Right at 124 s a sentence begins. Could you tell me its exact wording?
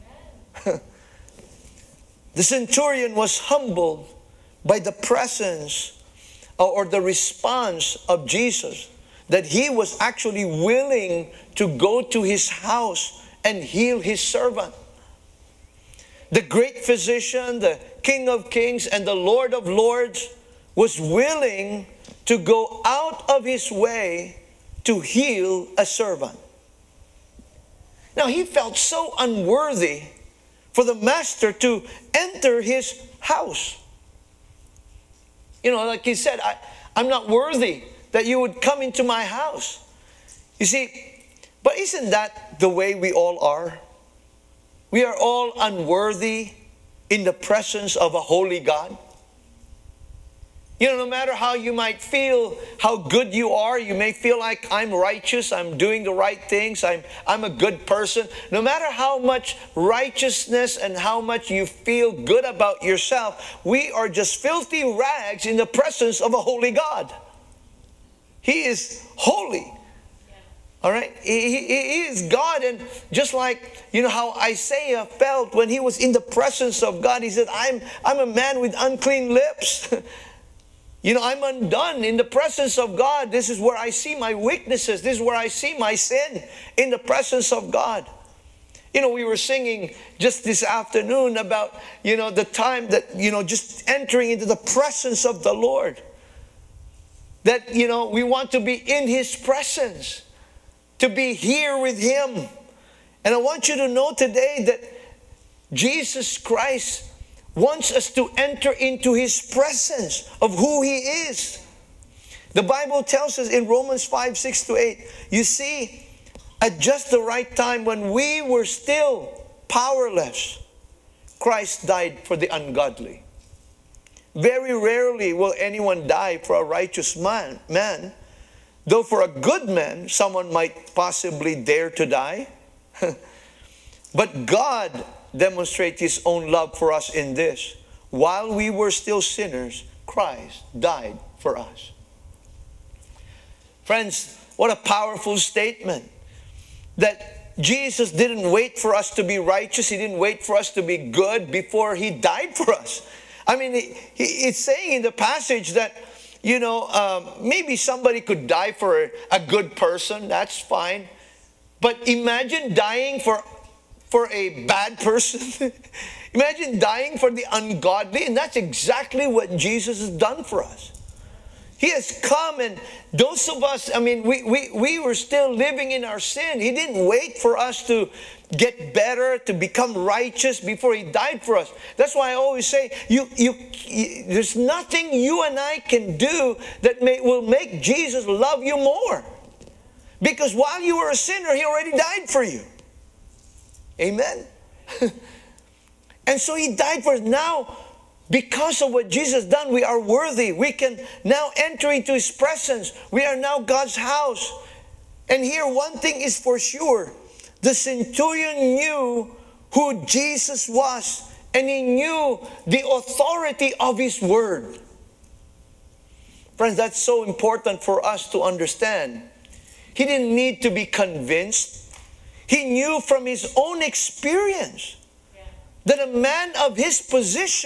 Very rarely will anyone die for a righteous man, man, though for a good man, someone might possibly dare to die.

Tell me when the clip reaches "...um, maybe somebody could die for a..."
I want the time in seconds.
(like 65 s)
156 s.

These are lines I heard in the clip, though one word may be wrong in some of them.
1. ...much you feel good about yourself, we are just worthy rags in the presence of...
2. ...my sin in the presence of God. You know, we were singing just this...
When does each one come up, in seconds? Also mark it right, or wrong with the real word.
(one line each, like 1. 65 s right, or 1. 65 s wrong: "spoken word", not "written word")
1. 61 s wrong: "filthy", not "worthy"
2. 85 s right.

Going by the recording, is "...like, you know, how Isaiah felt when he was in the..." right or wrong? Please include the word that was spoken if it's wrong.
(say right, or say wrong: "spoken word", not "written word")
right.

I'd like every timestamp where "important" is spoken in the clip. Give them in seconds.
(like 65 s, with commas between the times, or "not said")
217 s.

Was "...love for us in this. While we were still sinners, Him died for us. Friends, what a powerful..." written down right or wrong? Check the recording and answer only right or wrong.
wrong.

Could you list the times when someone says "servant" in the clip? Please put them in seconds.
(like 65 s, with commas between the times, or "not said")
14 s, 25 s.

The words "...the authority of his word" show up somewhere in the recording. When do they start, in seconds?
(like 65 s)
212 s.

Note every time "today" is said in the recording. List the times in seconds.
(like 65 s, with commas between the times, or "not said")
104 s.